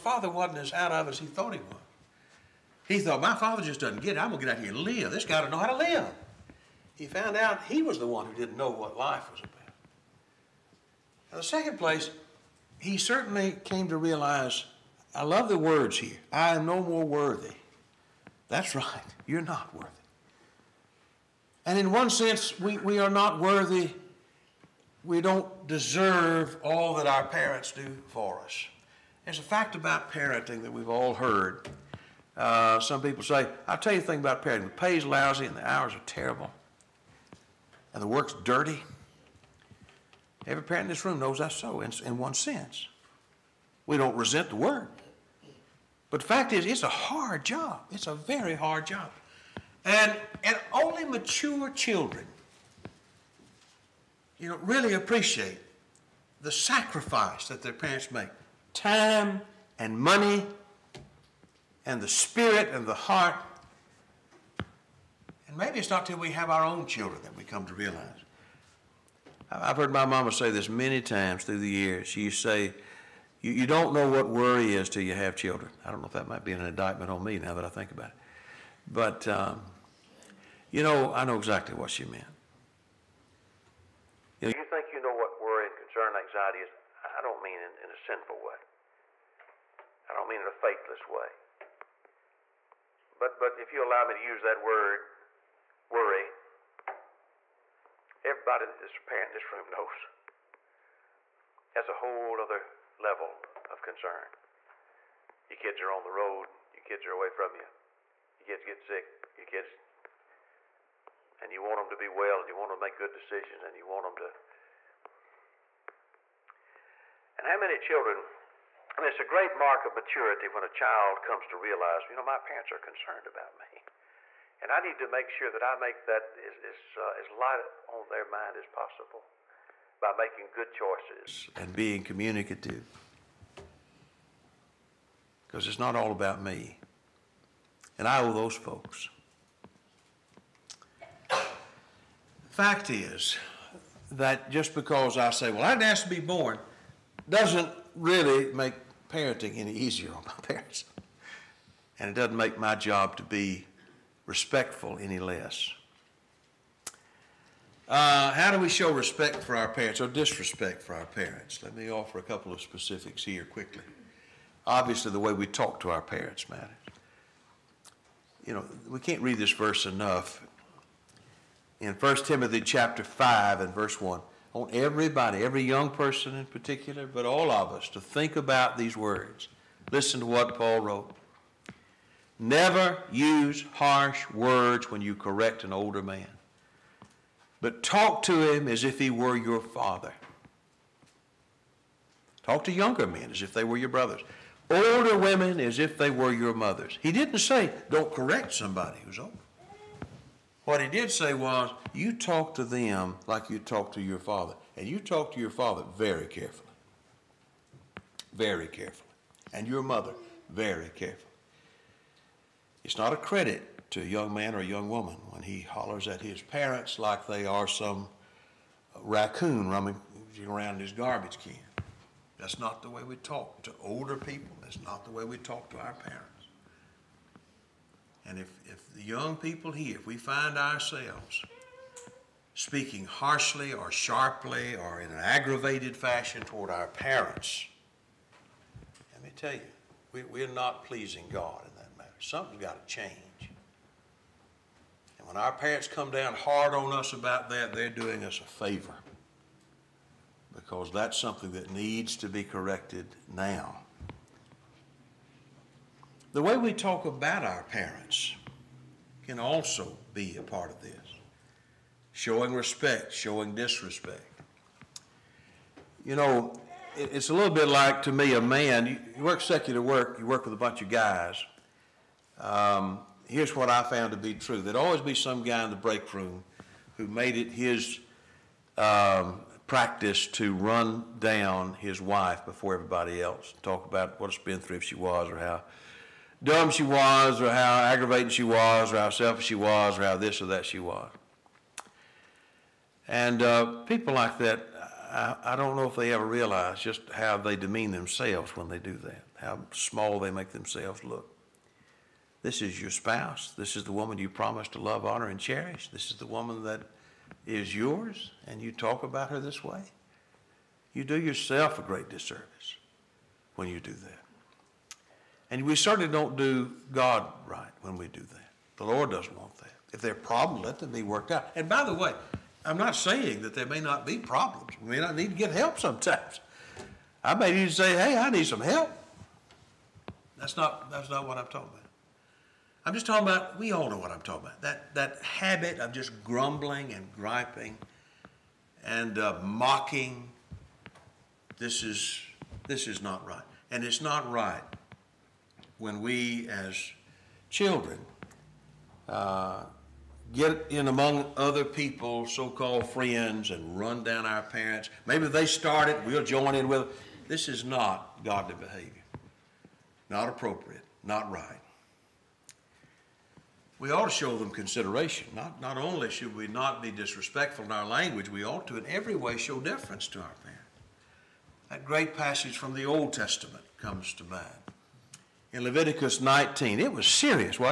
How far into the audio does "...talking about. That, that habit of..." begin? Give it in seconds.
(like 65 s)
334 s.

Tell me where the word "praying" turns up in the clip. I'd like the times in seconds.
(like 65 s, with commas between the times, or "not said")
not said.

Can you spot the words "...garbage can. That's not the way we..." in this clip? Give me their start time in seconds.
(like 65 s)
220 s.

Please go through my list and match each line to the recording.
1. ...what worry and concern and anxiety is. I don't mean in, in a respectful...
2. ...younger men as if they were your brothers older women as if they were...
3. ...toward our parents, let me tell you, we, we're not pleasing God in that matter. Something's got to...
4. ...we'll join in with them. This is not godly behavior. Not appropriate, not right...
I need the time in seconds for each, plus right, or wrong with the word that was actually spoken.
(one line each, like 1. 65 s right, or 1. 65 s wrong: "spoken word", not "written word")
1. 85 s wrong: "sinful", not "respectful"
2. 192 s right
3. 236 s right
4. 356 s right.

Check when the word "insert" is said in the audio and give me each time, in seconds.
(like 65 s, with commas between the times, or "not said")
not said.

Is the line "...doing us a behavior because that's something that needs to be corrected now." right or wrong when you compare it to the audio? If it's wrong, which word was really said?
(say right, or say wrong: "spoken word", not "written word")
wrong: "favor", not "behavior".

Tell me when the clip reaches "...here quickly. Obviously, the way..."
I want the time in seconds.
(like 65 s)
163 s.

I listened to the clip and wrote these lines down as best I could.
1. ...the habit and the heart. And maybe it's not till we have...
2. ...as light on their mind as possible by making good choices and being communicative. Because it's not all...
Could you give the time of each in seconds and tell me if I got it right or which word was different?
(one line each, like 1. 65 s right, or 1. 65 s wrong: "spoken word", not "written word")
1. 62 s wrong: "spirit", not "habit"
2. 127 s right.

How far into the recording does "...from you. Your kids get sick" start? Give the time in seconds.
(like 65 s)
107 s.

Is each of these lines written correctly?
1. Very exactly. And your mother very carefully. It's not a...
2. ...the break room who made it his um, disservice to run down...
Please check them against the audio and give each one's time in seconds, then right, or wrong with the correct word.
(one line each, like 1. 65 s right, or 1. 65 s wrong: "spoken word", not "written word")
1. 208 s wrong: "carefully", not "exactly"
2. 275 s wrong: "practice", not "disservice".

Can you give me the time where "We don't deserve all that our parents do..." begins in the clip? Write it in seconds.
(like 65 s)
25 s.